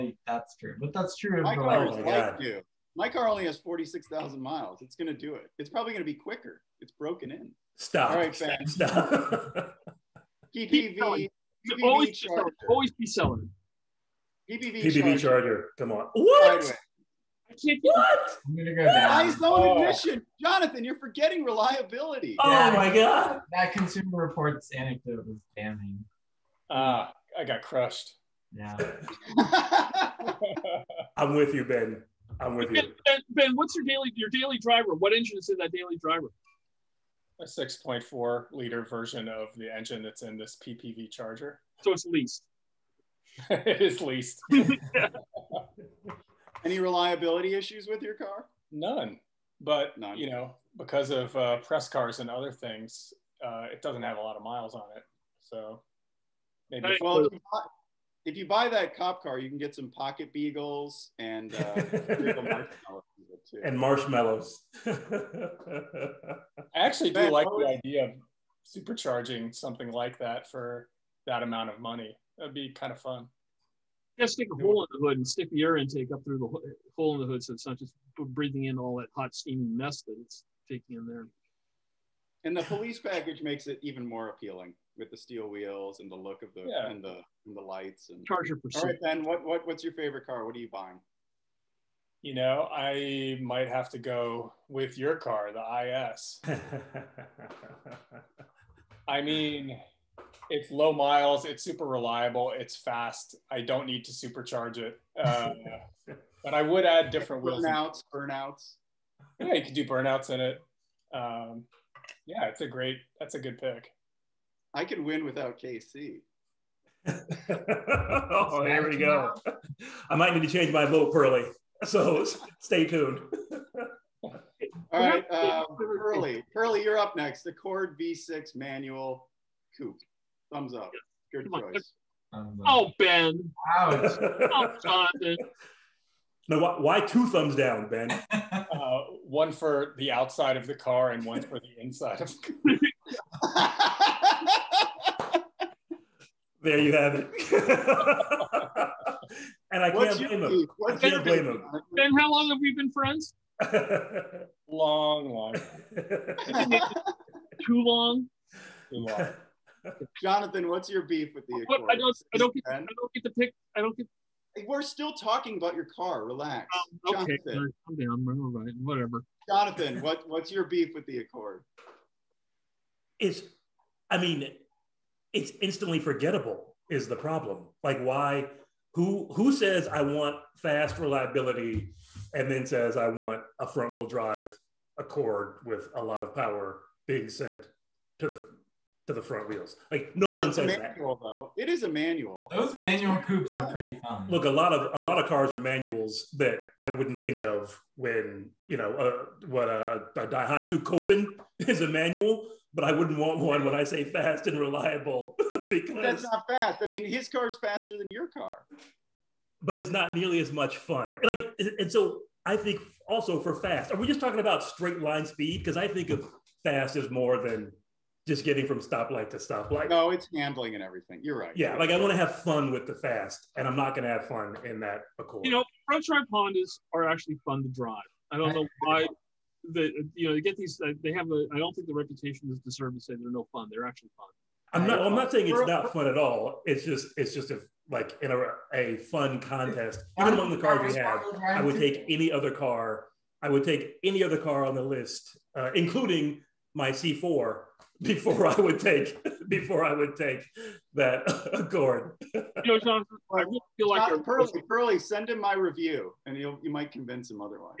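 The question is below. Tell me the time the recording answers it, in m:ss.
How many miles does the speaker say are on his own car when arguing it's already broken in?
0:03.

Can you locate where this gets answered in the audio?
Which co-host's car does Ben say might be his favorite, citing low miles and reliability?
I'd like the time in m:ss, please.
1:35.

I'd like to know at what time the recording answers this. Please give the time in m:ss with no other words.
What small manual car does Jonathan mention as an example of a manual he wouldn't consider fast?
3:20.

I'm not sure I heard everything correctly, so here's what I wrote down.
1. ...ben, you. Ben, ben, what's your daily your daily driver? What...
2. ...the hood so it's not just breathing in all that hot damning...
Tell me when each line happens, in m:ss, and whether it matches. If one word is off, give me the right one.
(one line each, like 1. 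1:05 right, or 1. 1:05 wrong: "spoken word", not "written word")
1. 0:32 right
2. 1:17 wrong: "steaming", not "damning".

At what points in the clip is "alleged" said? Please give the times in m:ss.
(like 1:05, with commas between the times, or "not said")
not said.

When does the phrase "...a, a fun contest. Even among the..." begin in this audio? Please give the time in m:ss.
3:58.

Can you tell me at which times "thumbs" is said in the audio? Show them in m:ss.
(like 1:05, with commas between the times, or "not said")
2:10, 2:17.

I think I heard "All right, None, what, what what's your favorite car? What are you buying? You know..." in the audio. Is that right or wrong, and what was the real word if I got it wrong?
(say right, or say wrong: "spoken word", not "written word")
wrong: "Ben", not "None".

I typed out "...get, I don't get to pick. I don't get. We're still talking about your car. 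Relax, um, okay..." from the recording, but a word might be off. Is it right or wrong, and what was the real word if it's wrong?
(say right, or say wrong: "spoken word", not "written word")
right.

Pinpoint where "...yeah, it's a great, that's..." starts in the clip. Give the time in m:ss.
1:52.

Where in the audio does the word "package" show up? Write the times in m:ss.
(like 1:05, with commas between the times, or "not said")
1:22.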